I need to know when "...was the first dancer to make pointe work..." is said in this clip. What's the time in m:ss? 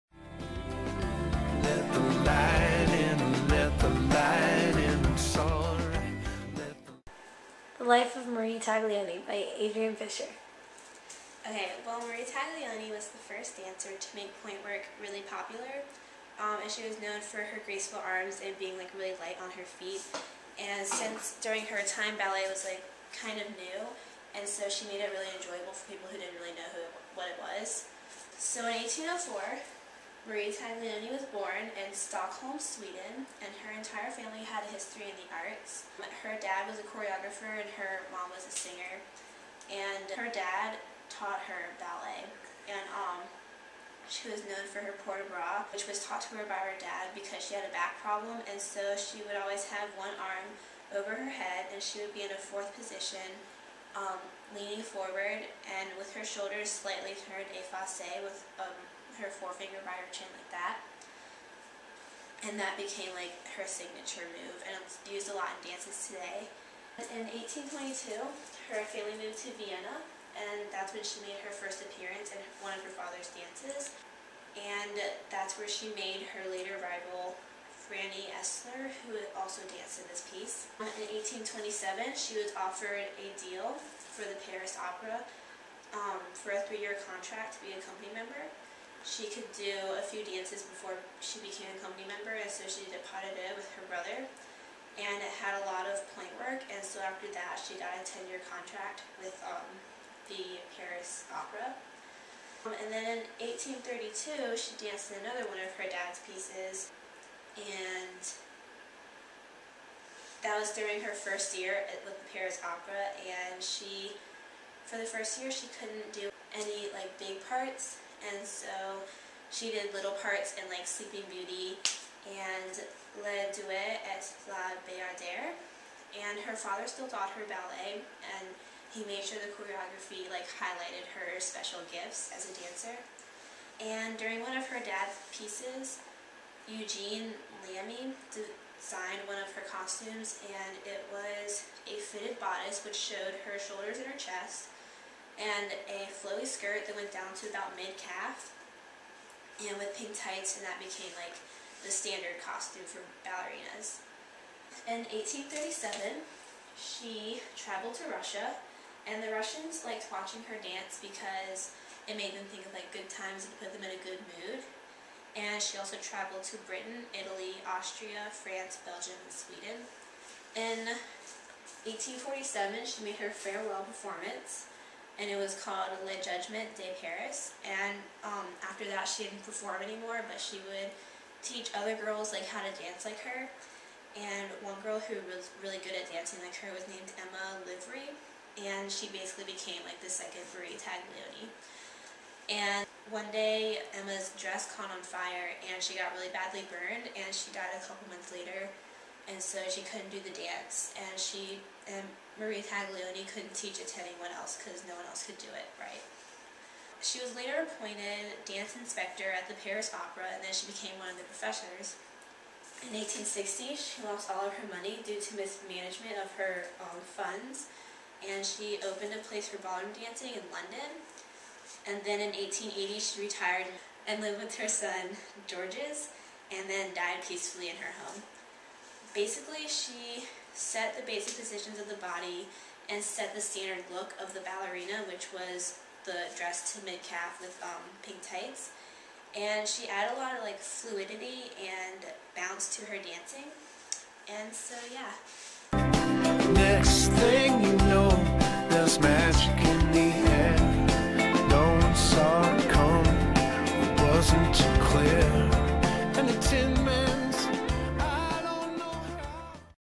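0:12.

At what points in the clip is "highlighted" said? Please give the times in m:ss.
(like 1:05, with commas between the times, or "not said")
2:10.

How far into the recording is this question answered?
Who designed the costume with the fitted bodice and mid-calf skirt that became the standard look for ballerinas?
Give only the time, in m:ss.
2:16.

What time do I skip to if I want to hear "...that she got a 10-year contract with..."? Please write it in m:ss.
1:37.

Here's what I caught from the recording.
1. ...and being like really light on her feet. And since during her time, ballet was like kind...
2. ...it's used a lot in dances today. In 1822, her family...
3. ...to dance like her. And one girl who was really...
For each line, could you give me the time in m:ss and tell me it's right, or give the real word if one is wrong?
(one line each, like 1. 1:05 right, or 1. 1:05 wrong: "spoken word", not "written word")
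1. 0:18 right
2. 1:04 right
3. 3:02 right.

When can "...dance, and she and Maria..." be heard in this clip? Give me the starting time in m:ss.
3:20.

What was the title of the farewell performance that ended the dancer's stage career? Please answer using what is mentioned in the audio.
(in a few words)
Le Judgment de Paris.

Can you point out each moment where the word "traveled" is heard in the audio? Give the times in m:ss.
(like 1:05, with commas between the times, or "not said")
2:37, 2:46.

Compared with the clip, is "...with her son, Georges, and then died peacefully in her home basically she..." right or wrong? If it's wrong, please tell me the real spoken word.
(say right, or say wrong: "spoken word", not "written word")
right.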